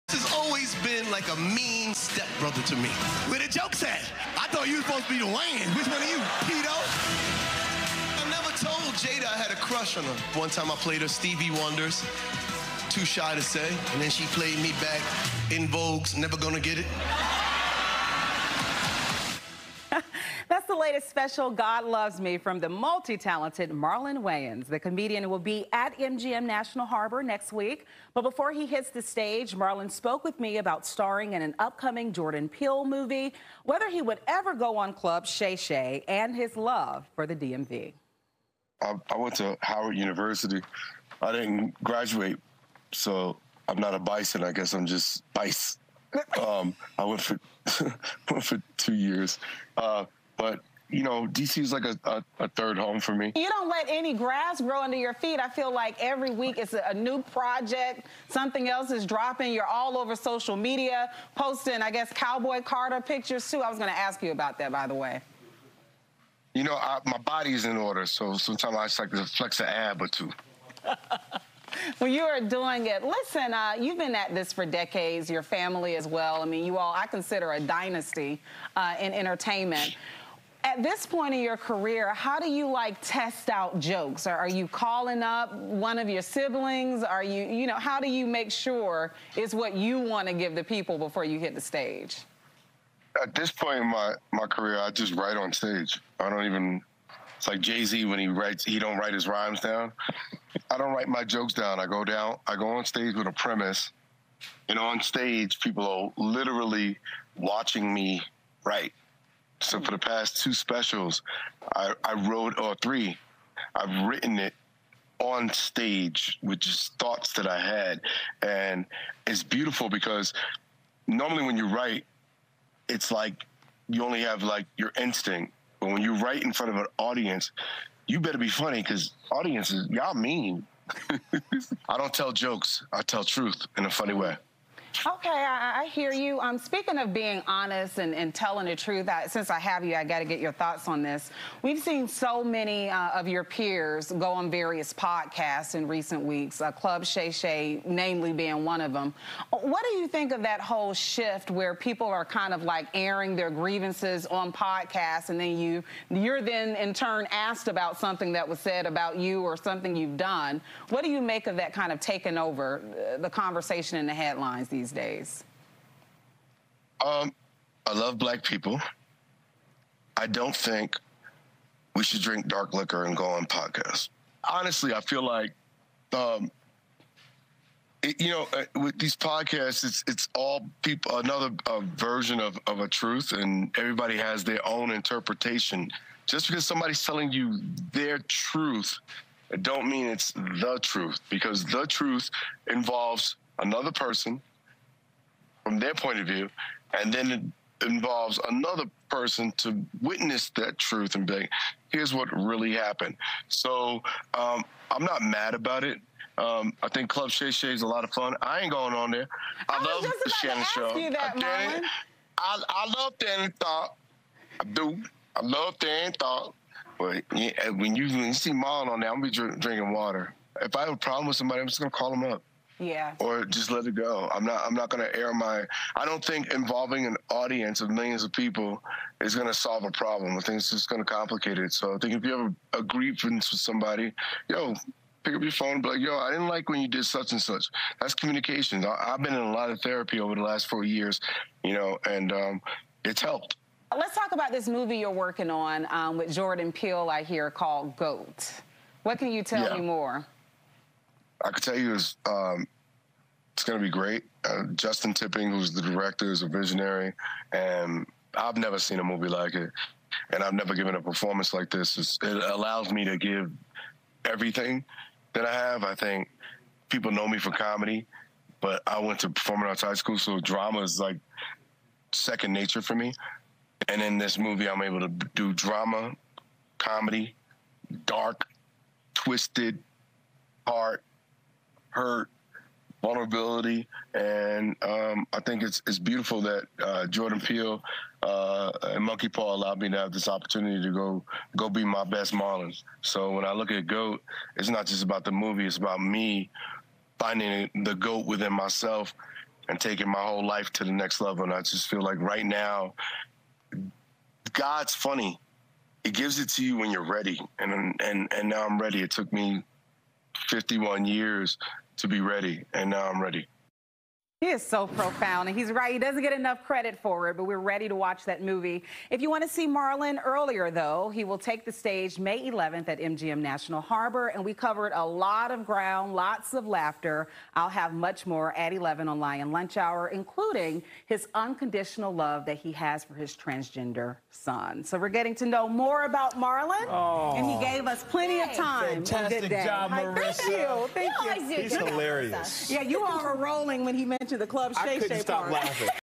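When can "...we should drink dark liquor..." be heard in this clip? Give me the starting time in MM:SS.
02:51.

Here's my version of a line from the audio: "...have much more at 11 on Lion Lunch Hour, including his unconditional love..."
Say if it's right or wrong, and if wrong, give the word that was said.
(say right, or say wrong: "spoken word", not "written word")
right.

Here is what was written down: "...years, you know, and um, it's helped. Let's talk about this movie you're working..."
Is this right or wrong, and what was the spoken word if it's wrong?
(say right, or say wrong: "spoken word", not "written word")
right.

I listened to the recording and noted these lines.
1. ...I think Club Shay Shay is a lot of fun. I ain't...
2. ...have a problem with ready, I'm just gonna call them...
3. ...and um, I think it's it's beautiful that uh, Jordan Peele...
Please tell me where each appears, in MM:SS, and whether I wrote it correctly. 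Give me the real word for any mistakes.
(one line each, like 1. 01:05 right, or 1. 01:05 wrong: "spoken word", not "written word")
1. 03:26 right
2. 03:40 wrong: "somebody", not "ready"
3. 04:44 right.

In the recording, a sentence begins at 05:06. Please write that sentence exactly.
It gives it to you when you're ready, and and and now I'm ready.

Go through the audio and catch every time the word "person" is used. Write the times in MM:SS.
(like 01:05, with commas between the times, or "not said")
03:13, 03:19.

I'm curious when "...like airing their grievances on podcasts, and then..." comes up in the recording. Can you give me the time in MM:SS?
02:32.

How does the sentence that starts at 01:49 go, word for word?
So for the past two specials, I, I wrote or three, I've written it on stage with just thoughts that I had.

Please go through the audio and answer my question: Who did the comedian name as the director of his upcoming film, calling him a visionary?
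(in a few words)
Justin Tipping.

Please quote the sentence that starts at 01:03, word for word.
I was going to ask you about that, by the way.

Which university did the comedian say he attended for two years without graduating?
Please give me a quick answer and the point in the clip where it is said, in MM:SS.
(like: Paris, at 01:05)
Howard University, at 00:39.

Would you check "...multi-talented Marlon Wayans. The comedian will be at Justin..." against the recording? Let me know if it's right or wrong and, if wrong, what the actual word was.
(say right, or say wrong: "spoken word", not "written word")
wrong: "MGM", not "Justin".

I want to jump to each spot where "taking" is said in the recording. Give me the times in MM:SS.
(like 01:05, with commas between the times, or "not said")
02:41, 04:59.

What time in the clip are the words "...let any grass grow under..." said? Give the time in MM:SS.
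00:53.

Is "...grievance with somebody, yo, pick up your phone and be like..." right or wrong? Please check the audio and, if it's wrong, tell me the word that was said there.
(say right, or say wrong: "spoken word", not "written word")
right.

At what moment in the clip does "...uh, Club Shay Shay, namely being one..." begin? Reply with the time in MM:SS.
02:26.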